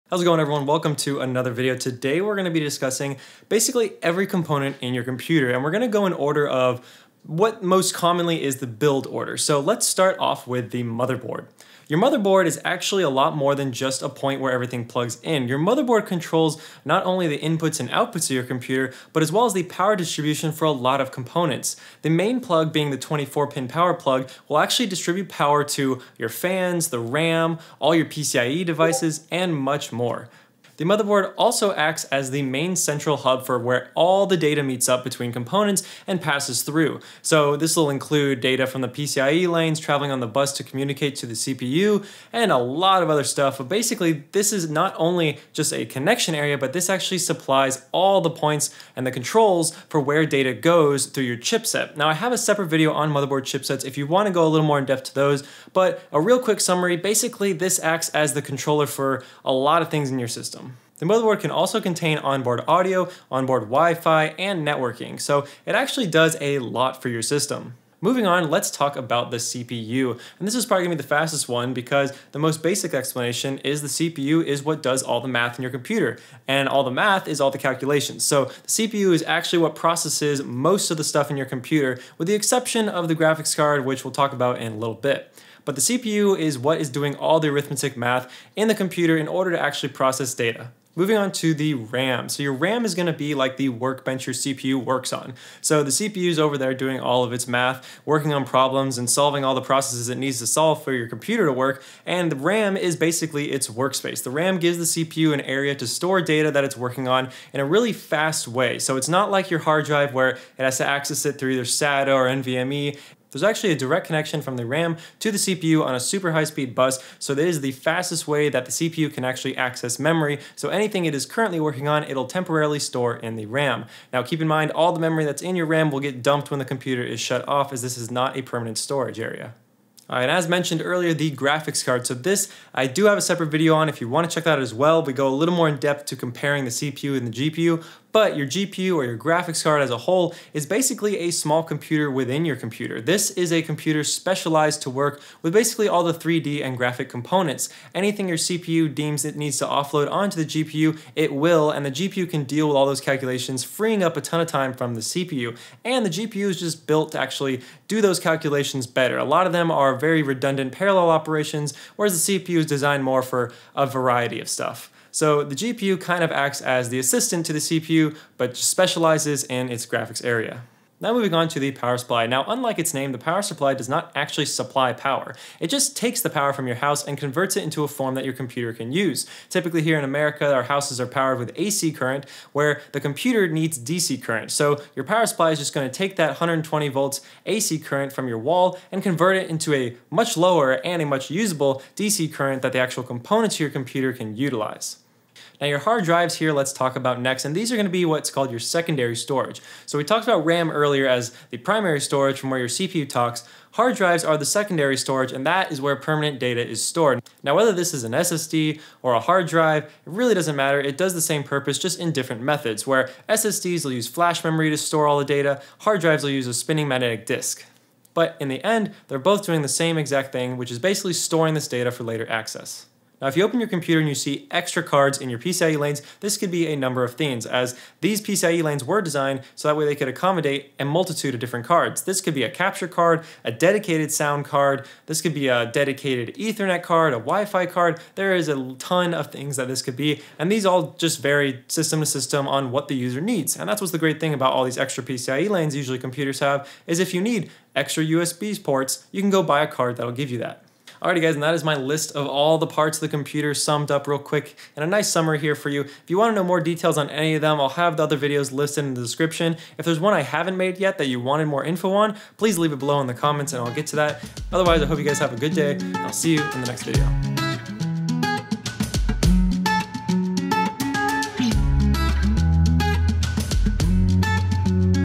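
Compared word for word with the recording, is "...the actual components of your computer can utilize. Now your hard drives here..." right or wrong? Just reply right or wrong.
right.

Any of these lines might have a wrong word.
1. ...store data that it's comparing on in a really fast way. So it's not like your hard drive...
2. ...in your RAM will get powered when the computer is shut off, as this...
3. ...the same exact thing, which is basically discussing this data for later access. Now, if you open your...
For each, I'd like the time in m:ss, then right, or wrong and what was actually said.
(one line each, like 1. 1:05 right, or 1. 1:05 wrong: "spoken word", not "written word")
1. 1:45 wrong: "working", not "comparing"
2. 2:05 wrong: "dumped", not "powered"
3. 3:39 wrong: "storing", not "discussing".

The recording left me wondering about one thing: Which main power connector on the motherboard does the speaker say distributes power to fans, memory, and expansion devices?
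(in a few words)
24-pin power plug.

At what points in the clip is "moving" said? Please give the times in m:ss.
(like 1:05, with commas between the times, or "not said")
1:08, 1:30, 2:51.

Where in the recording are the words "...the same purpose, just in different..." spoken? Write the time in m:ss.
3:31.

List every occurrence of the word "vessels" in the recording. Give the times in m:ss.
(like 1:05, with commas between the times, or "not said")
not said.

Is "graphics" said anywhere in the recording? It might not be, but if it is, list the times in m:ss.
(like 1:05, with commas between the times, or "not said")
1:23, 2:11, 2:19, 2:26, 2:49.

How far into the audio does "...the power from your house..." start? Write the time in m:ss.
2:56.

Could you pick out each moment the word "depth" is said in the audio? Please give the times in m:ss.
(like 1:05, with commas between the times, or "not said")
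0:54, 2:15.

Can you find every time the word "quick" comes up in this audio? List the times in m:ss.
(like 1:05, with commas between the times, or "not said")
0:56, 4:14.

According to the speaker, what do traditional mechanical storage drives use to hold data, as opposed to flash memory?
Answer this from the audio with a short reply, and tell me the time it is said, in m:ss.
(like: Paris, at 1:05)
spinning magnetic disk, at 3:36.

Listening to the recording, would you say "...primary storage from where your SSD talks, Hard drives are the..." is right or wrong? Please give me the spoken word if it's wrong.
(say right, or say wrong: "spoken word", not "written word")
wrong: "CPU", not "SSD".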